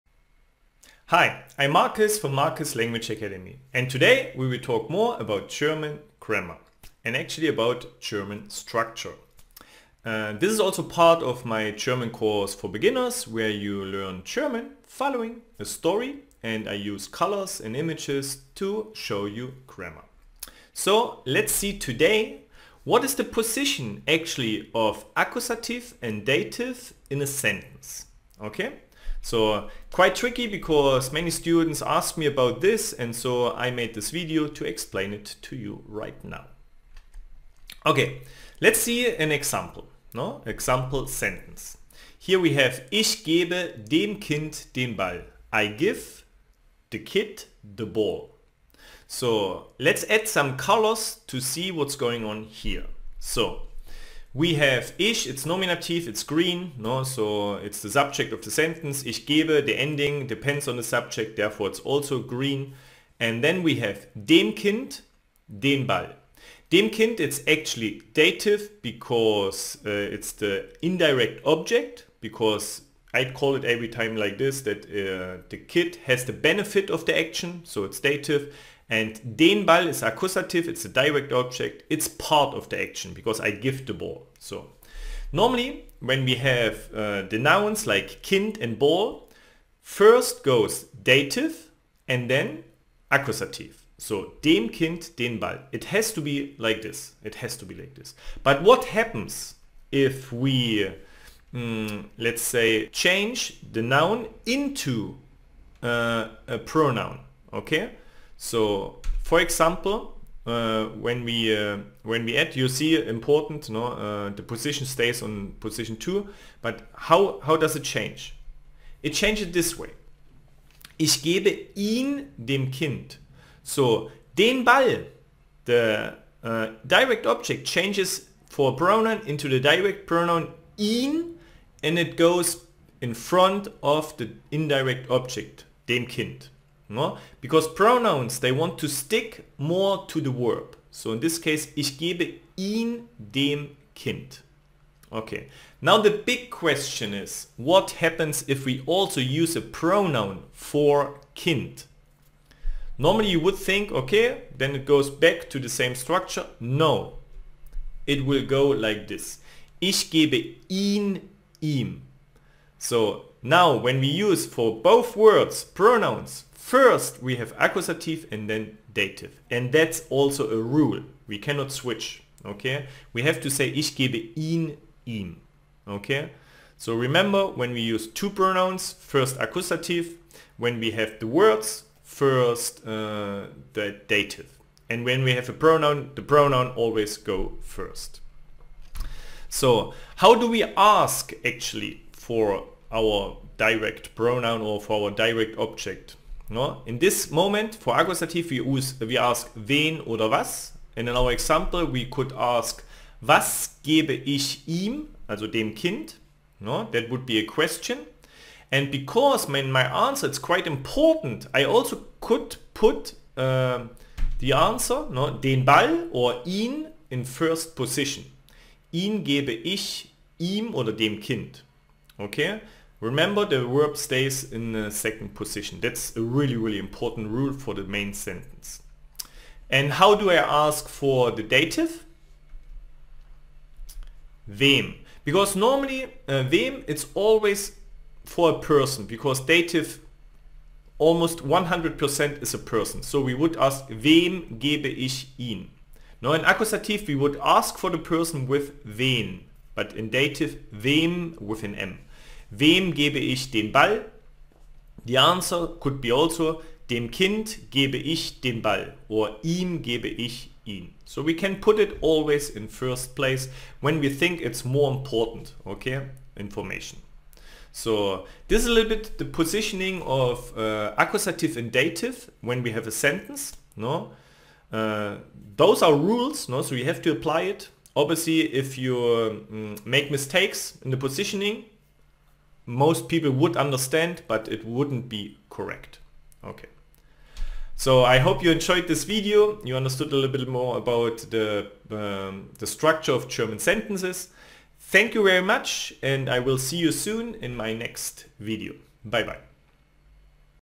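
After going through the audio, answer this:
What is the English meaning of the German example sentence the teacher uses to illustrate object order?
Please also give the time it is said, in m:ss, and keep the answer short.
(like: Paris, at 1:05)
I give the kid the ball, at 0:45.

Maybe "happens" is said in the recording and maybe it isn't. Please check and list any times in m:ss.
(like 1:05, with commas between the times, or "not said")
1:38, 2:27.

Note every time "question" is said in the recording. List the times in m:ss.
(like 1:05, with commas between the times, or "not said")
2:26, 3:27.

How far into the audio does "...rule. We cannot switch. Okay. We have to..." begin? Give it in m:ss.
2:50.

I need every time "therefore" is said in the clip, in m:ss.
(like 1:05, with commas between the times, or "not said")
1:01.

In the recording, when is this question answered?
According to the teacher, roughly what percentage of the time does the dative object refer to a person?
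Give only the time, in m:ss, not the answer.
4:01.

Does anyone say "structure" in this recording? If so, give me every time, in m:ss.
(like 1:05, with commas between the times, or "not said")
0:08, 2:35, 4:52.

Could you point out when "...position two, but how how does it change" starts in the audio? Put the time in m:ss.
1:55.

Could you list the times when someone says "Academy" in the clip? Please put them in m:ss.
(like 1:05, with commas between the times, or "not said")
0:03.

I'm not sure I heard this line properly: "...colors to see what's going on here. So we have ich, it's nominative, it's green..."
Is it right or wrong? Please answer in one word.
right.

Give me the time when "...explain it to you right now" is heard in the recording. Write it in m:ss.
0:34.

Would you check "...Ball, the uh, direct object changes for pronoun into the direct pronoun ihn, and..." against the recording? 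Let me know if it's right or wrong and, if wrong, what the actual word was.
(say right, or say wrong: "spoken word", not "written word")
right.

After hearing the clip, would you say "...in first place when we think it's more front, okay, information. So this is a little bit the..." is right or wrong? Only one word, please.
wrong.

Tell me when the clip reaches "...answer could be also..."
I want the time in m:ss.
4:15.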